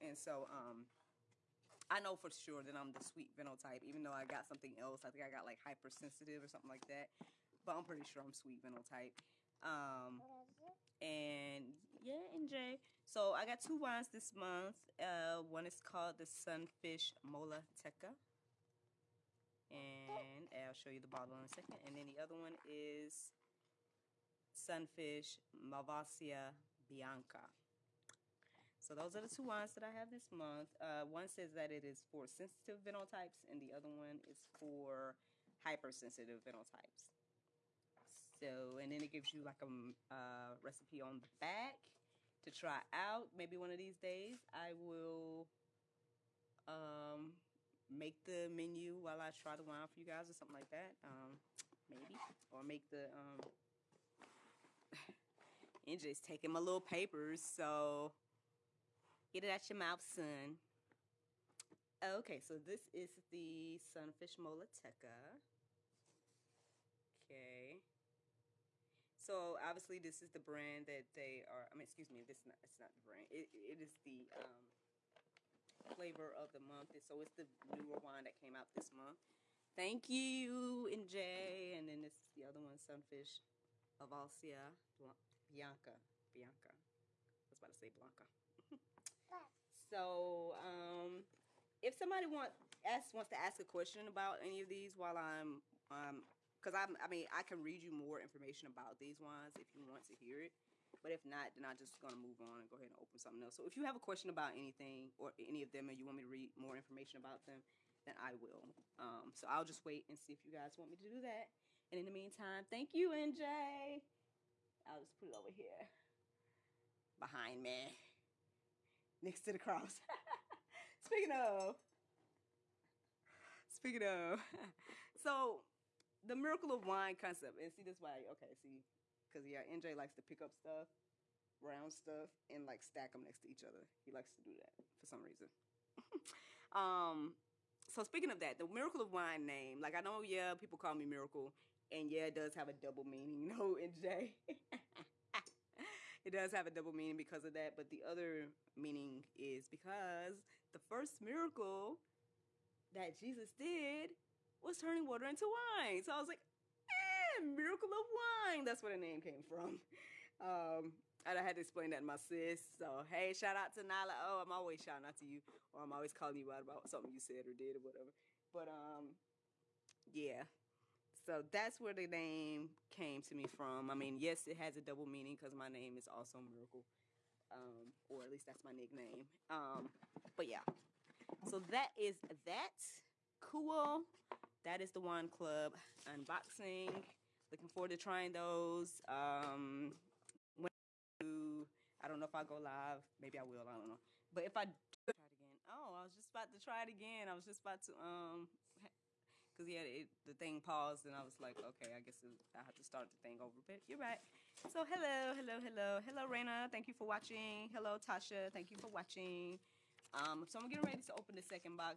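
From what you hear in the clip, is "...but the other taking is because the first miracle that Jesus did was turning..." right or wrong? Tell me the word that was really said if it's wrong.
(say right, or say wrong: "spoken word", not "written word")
wrong: "meaning", not "taking".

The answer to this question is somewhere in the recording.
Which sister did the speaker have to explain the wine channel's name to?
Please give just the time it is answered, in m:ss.
2:43.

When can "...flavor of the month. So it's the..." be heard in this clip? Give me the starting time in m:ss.
1:15.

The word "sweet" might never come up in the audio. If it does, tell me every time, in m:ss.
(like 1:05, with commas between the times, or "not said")
0:03, 0:08.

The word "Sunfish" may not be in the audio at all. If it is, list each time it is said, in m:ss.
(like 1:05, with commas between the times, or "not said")
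0:16, 0:24, 1:03, 1:22.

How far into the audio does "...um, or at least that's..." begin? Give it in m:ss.
2:57.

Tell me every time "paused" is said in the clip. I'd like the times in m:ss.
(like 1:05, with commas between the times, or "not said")
3:20.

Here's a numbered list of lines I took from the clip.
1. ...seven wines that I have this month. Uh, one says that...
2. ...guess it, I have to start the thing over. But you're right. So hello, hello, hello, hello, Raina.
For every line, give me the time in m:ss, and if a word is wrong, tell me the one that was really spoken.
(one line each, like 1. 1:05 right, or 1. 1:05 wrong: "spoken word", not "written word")
1. 0:29 wrong: "two", not "seven"
2. 3:21 right.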